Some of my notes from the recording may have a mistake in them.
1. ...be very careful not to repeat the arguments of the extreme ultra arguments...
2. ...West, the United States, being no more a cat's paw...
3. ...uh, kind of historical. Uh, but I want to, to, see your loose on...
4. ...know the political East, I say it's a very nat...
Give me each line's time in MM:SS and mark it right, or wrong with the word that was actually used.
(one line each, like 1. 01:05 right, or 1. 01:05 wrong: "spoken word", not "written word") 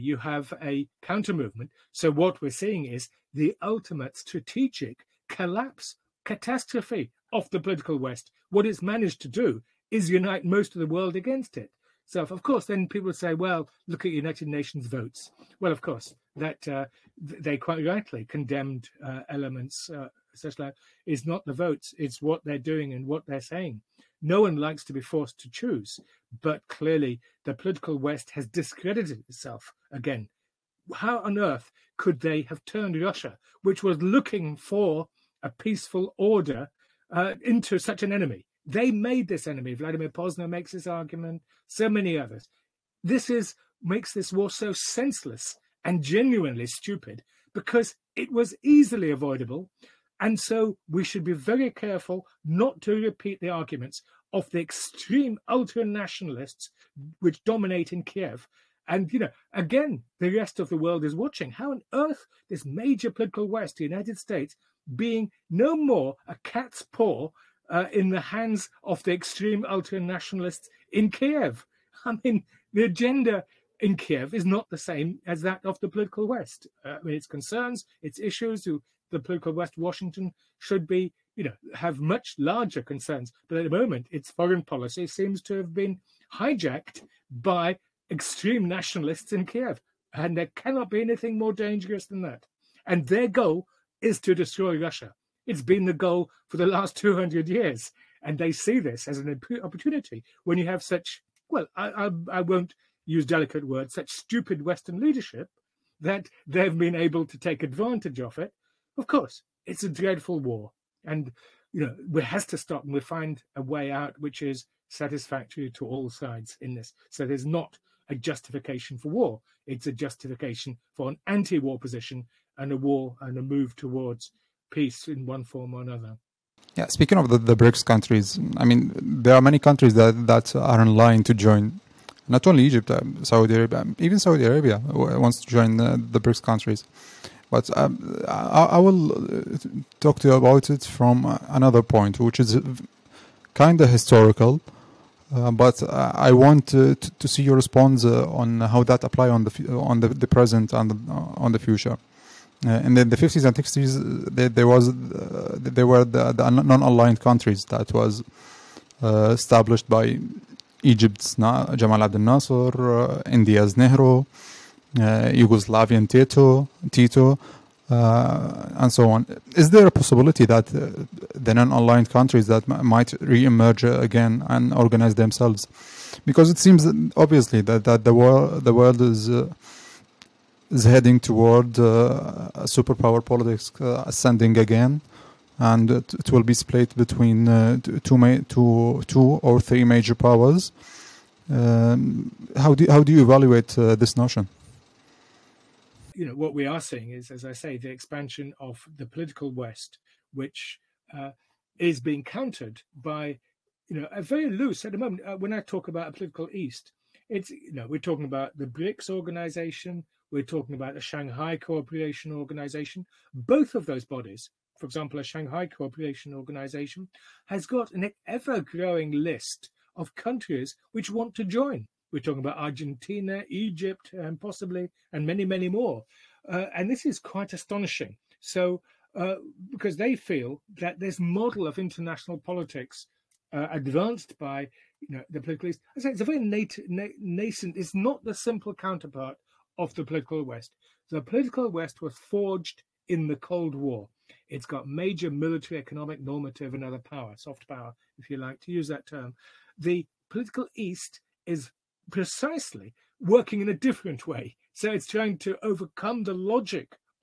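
1. 00:51 wrong: "nationalists", not "arguments"
2. 01:03 right
3. 02:22 wrong: "response", not "loose"
4. 03:55 right.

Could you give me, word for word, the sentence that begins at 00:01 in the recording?
So what we're seeing is the ultimate strategic collapse, catastrophe of the political West.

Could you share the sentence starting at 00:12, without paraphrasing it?
So, of course, then people say, well, look at United Nations votes.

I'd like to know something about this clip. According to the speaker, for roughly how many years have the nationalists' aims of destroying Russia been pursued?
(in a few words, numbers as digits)
200 years.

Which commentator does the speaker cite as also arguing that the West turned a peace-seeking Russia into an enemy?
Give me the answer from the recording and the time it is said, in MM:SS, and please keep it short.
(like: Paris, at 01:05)
Vladimir Posner, at 00:39.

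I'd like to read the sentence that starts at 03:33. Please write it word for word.
Both of those bodies, for example, a Shanghai Cooperation Organization, has got an ever growing list of countries which want to join.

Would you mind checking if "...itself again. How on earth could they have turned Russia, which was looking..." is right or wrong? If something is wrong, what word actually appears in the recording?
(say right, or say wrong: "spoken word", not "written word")
right.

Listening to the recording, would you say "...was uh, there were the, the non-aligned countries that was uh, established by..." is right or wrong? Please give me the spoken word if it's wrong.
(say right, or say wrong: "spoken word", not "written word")
right.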